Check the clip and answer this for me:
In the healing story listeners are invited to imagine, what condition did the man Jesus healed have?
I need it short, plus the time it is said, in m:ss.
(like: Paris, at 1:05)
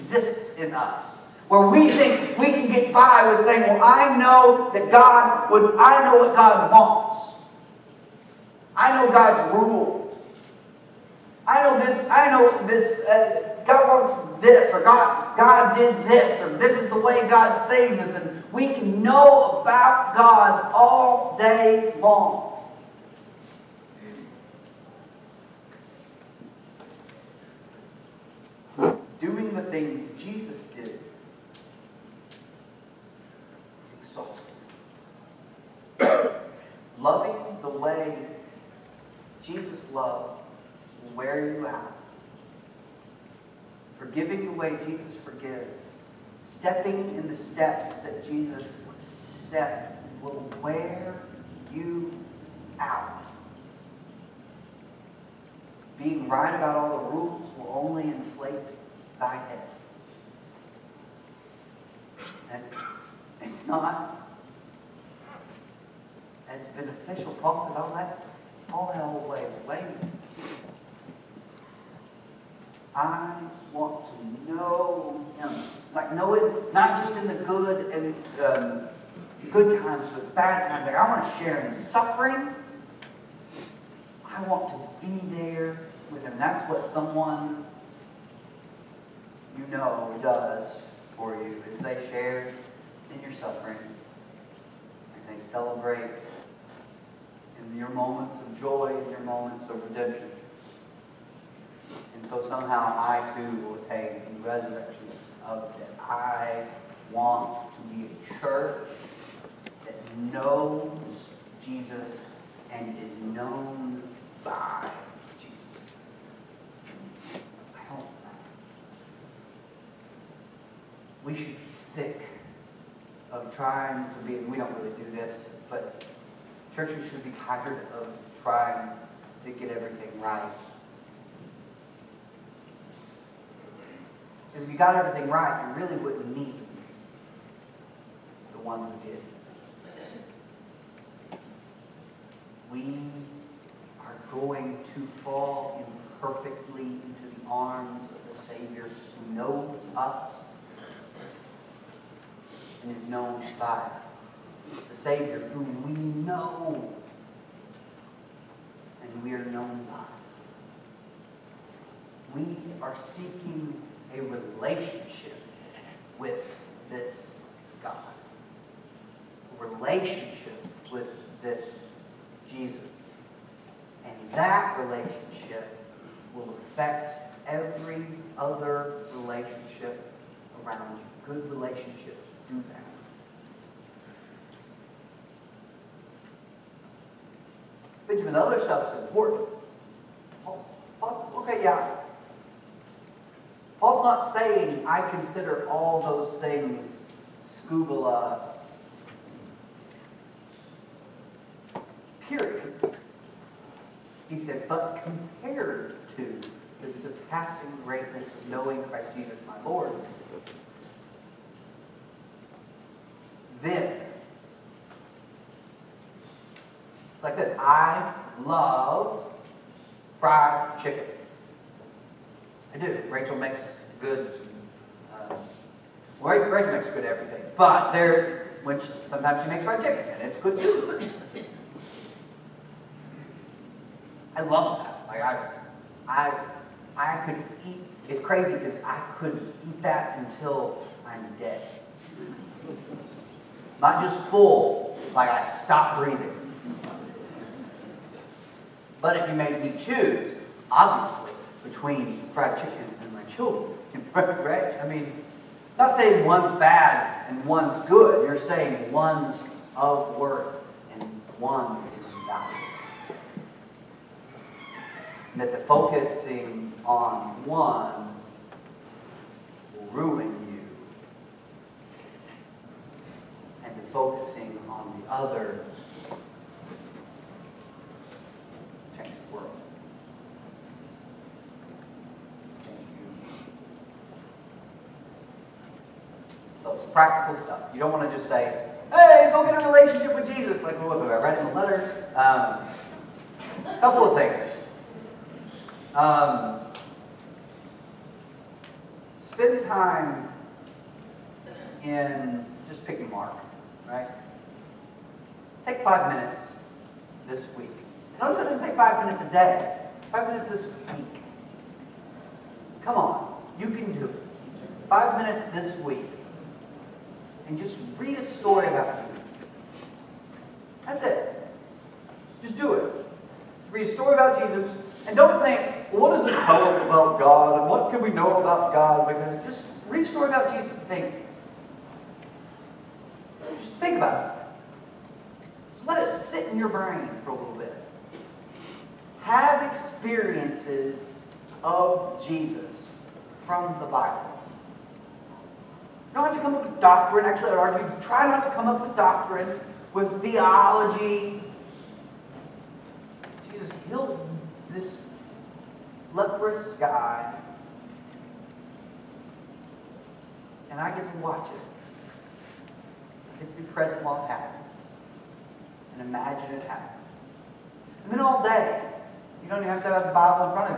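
leprous, at 5:56.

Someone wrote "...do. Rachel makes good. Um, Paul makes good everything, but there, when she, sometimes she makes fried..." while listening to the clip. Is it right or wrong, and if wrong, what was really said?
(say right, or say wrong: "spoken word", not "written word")
wrong: "Rachel", not "Paul".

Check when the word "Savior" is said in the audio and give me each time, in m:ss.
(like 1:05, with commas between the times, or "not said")
2:28, 2:34.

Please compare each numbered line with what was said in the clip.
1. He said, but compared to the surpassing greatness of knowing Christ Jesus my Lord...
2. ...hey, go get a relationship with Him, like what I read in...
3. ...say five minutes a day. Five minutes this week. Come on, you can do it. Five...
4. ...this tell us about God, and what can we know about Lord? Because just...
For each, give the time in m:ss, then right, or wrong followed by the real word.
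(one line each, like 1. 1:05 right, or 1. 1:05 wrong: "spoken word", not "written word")
1. 3:24 right
2. 4:48 wrong: "Jesus", not "Him"
3. 5:08 right
4. 5:26 wrong: "God", not "Lord".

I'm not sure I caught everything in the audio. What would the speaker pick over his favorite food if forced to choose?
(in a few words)
my children.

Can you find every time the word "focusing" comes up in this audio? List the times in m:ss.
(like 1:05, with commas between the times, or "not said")
4:25, 4:33.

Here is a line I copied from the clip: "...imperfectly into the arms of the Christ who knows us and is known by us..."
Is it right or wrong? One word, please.
wrong.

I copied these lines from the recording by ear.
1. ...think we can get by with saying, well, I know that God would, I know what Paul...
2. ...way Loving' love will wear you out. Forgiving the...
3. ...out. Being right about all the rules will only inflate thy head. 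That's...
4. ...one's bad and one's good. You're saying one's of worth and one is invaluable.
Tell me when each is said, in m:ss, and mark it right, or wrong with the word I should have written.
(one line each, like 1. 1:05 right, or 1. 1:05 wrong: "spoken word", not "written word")
1. 0:01 wrong: "God", not "Paul"
2. 0:37 wrong: "Jesus", not "Loving"
3. 0:52 right
4. 4:16 right.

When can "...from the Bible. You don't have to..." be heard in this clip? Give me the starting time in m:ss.
5:43.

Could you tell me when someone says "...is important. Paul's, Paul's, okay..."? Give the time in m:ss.
3:08.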